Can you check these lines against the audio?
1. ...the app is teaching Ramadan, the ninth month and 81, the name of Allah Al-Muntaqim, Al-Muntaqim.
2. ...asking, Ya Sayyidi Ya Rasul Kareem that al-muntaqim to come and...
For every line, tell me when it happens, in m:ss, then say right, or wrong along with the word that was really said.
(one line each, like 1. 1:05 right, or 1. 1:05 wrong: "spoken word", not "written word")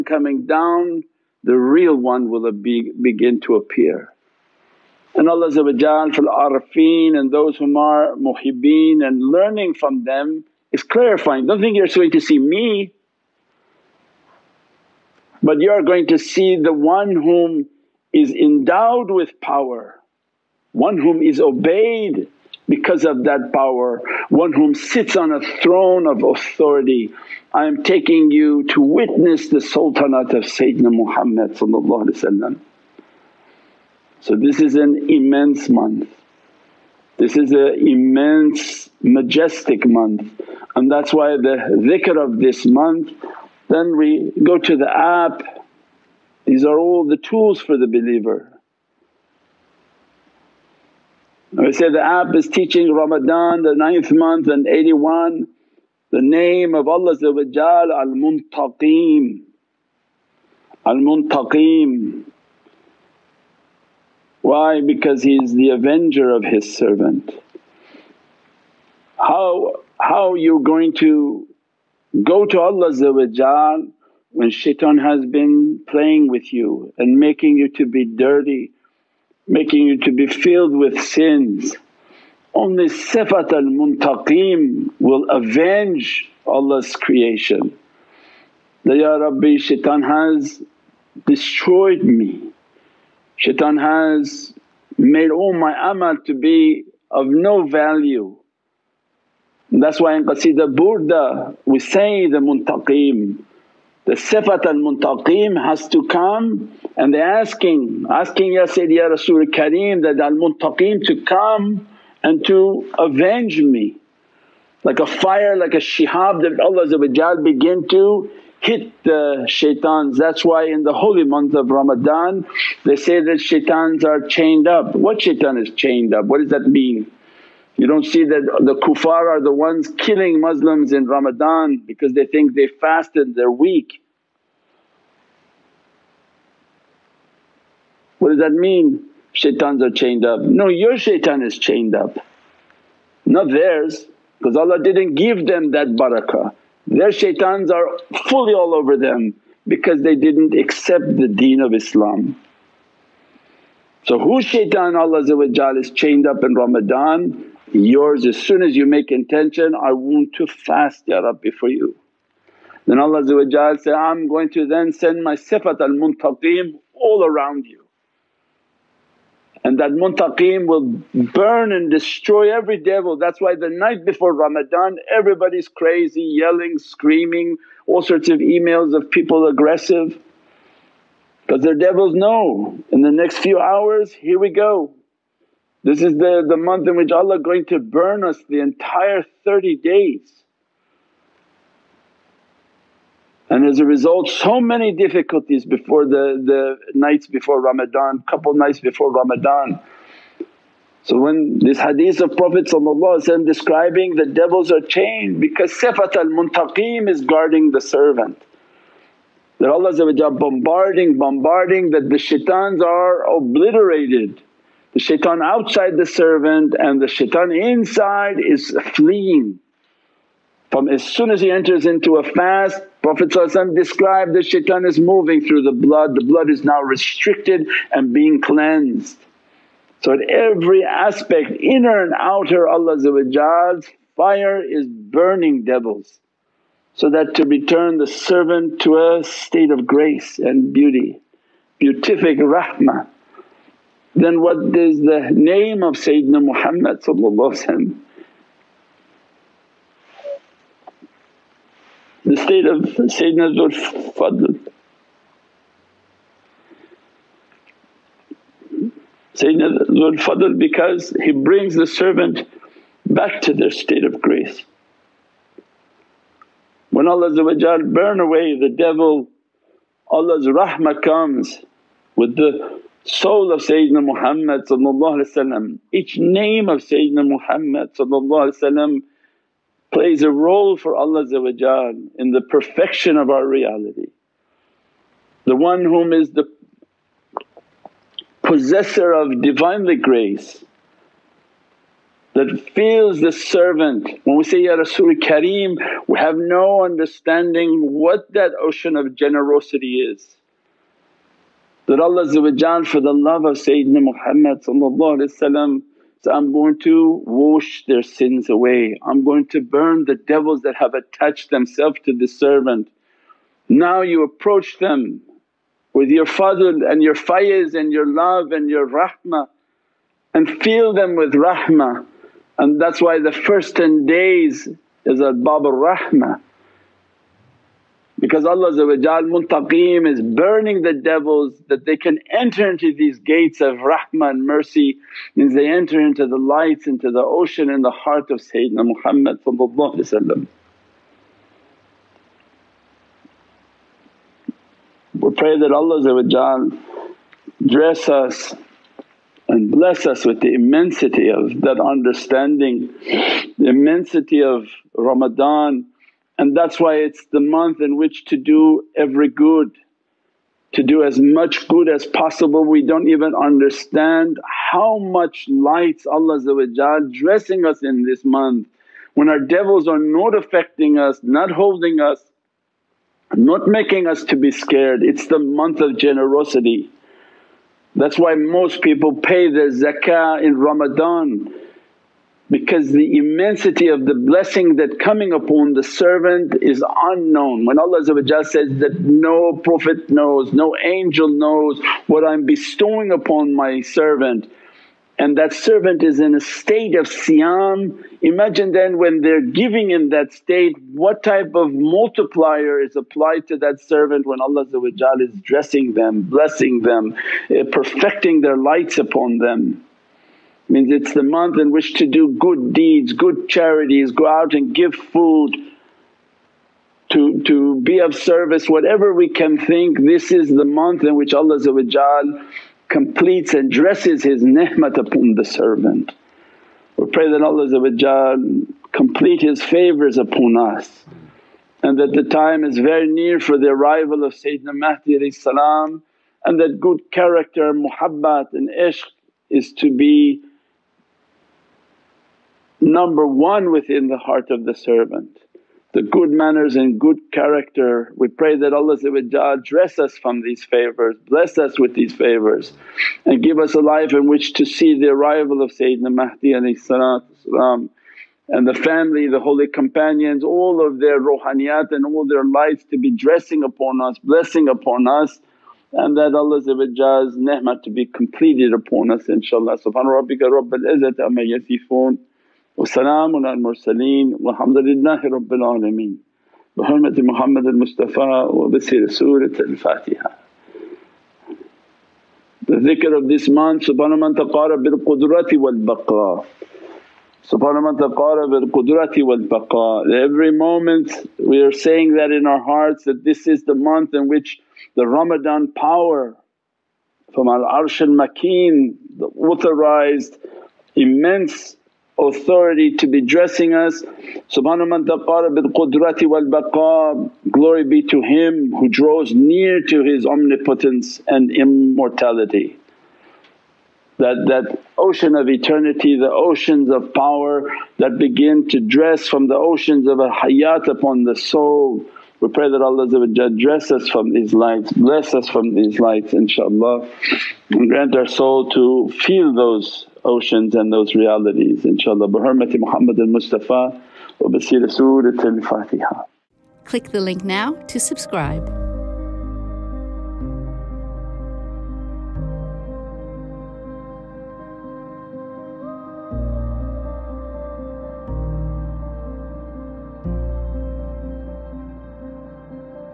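1. 0:51 right
2. 1:48 right.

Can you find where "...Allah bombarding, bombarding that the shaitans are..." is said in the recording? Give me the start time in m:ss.
3:29.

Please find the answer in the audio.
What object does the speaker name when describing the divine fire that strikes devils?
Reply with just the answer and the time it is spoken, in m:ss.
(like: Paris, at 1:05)
a shihab, at 1:55.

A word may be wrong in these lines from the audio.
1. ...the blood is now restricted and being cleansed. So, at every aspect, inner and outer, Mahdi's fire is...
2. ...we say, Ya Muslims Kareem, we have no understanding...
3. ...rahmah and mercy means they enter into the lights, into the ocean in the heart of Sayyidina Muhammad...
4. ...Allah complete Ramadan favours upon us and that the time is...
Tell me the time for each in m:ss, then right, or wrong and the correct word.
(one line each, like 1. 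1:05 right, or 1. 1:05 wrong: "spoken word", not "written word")
1. 3:46 wrong: "Allah", not "Mahdi"
2. 4:54 wrong: "Rasul", not "Muslims"
3. 5:33 right
4. 7:07 wrong: "His", not "Ramadan".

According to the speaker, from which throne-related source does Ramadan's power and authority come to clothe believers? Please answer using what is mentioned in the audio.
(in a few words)
Al Arsh al makin.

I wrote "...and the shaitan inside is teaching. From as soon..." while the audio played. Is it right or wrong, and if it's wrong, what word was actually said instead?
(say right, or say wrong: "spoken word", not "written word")
wrong: "fleeing", not "teaching".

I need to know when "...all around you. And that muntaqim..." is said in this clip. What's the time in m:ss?
2:46.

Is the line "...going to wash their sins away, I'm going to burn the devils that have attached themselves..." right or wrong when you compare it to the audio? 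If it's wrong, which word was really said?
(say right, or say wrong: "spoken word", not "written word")
right.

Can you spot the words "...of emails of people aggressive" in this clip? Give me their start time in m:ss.
2:58.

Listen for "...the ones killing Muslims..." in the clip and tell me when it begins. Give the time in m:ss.
2:09.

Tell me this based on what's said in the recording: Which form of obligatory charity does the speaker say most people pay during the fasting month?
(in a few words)
zakah.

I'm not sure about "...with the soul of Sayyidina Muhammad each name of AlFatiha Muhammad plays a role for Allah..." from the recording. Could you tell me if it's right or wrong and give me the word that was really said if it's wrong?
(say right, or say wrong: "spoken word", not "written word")
wrong: "Sayyidina", not "AlFatiha".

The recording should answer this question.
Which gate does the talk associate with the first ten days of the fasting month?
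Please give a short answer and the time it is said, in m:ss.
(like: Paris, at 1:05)
Bab rahmah, at 5:25.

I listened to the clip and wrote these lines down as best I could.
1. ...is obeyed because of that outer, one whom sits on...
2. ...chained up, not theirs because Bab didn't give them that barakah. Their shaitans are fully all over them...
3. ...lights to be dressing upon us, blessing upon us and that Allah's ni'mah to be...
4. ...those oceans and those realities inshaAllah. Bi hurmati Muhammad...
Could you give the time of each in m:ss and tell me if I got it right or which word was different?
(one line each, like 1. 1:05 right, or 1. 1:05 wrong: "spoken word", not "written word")
1. 0:21 wrong: "power", not "outer"
2. 2:21 wrong: "Allah", not "Bab"
3. 7:42 right
4. 8:49 right.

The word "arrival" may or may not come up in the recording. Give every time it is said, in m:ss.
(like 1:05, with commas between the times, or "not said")
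7:13, 7:35.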